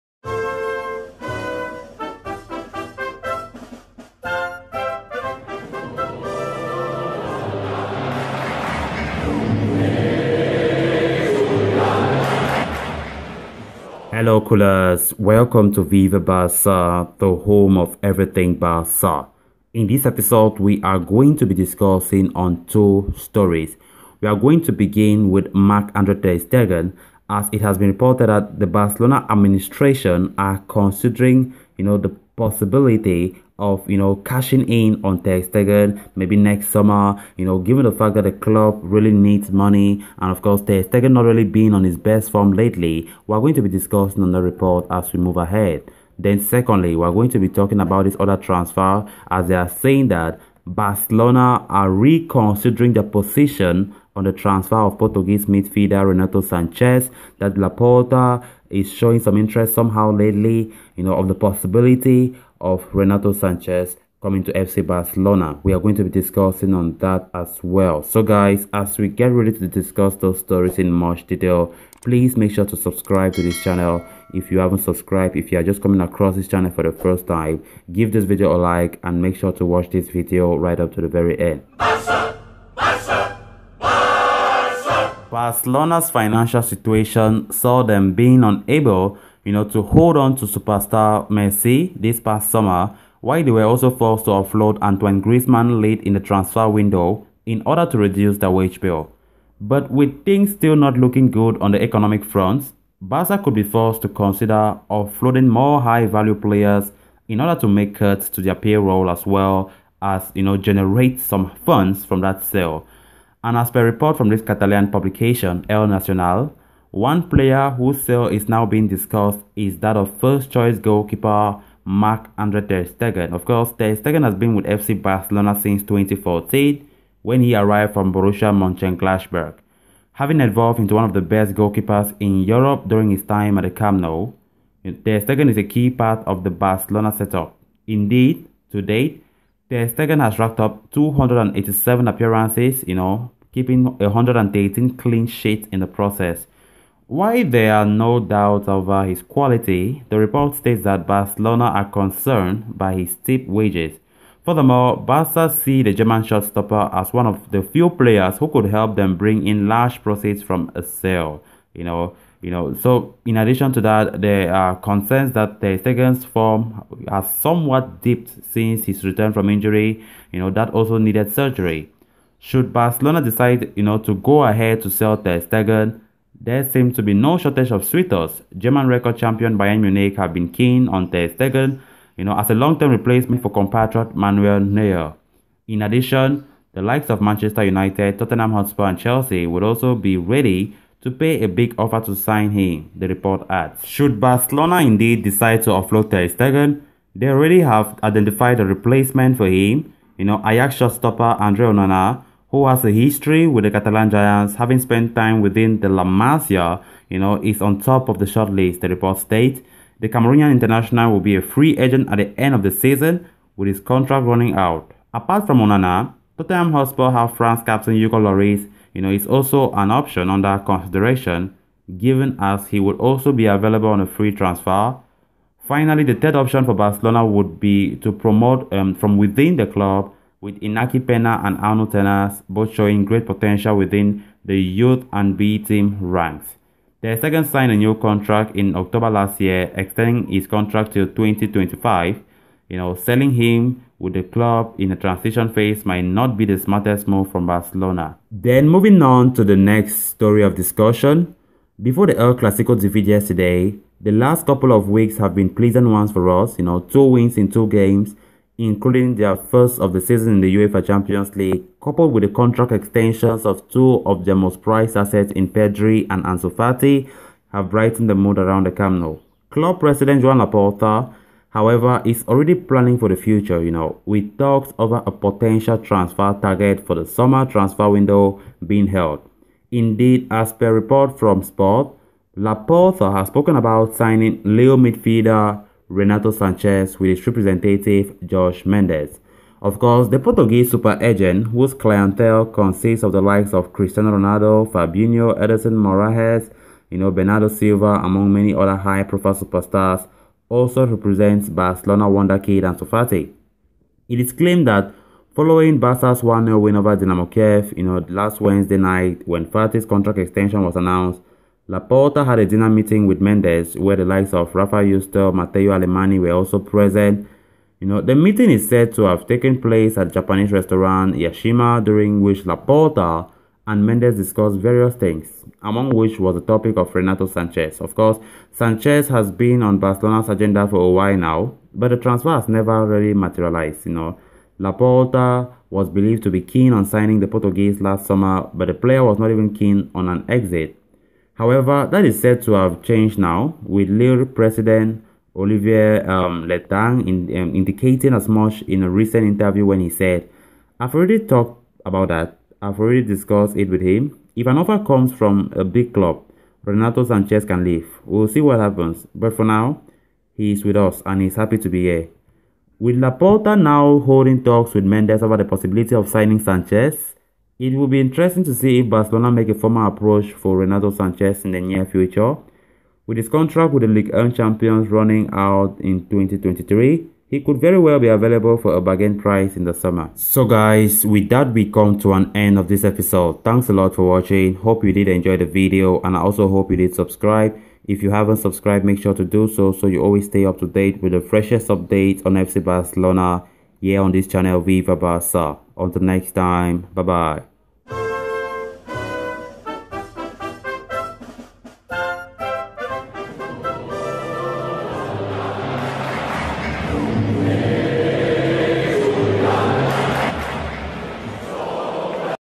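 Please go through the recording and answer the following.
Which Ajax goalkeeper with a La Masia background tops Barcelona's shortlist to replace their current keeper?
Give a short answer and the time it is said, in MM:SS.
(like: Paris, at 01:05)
Andre Onana, at 03:21.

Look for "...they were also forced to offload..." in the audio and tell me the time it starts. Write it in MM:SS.
01:33.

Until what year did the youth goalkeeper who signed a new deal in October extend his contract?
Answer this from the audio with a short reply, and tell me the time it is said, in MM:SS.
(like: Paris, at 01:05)
2025, at 04:01.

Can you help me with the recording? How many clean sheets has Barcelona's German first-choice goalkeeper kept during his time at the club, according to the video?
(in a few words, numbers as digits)
118.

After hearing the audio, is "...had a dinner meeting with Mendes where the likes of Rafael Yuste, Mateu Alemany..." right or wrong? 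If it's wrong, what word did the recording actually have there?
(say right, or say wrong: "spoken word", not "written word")
right.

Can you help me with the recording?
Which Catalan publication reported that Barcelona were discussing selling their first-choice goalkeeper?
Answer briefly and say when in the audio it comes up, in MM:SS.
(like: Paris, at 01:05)
El Nacional, at 01:55.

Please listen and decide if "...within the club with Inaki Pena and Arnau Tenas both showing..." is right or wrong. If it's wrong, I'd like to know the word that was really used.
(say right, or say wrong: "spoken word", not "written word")
right.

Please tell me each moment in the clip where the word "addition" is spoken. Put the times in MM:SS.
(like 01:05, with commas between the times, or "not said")
02:43, 03:05.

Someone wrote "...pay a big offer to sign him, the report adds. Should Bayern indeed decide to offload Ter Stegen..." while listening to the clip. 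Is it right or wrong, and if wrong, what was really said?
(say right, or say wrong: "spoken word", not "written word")
wrong: "Barcelona", not "Bayern".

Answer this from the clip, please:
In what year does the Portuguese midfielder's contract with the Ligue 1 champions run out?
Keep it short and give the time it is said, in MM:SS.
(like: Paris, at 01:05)
2023, at 06:16.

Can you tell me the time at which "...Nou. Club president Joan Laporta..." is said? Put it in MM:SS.
04:29.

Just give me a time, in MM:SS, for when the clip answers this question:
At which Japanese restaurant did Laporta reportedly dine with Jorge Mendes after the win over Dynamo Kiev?
05:21.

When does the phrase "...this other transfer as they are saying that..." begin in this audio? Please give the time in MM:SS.
00:48.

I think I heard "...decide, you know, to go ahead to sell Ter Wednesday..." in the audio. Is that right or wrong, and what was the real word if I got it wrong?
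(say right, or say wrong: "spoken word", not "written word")
wrong: "Stegen", not "Wednesday".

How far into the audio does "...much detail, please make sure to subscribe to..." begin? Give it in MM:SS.
01:10.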